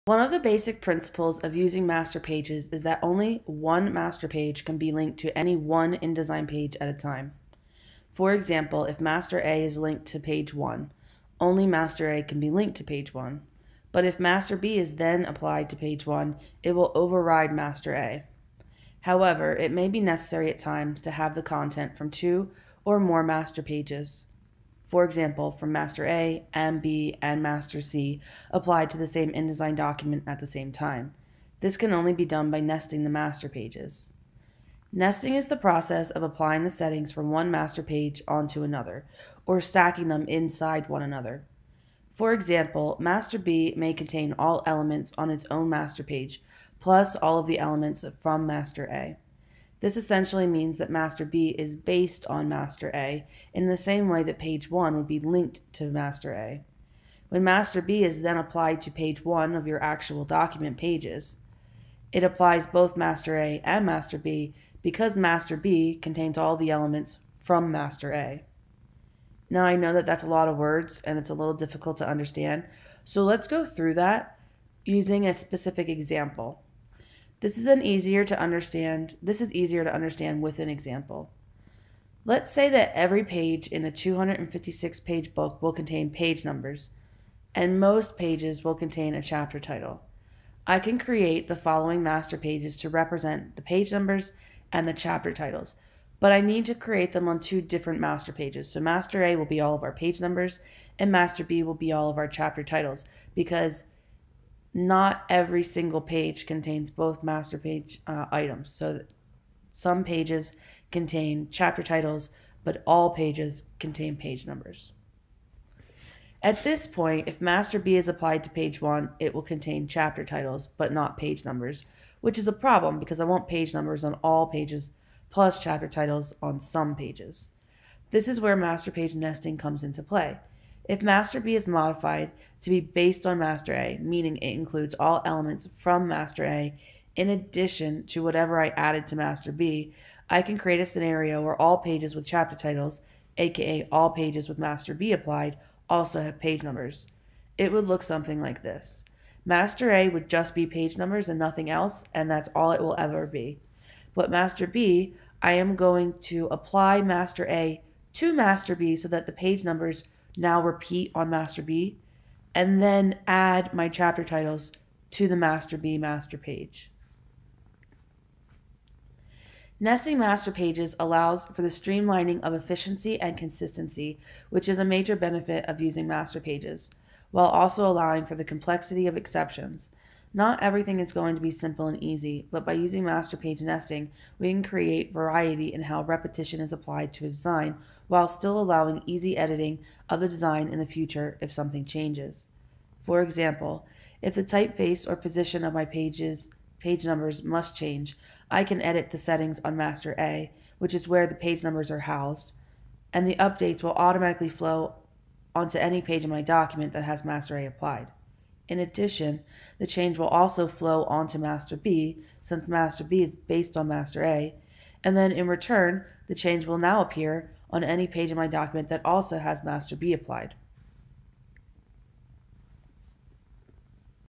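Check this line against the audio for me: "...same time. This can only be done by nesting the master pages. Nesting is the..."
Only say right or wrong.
right.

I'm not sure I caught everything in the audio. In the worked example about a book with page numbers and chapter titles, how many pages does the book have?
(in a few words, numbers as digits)
256.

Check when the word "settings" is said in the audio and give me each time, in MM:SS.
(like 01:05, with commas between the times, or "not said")
00:36, 03:19.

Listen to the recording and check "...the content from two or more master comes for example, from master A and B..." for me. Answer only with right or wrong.
wrong.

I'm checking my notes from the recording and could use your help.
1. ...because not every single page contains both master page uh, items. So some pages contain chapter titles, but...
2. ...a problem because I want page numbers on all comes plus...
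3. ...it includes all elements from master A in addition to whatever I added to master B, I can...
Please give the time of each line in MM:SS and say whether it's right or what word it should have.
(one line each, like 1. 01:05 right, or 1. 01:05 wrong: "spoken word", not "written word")
1. 01:43 right
2. 02:02 wrong: "pages", not "comes"
3. 02:14 right.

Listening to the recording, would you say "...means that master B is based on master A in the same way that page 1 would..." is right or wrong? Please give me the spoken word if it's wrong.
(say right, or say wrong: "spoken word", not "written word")
right.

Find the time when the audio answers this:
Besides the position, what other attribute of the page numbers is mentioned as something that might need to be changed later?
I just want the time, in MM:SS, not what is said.
03:14.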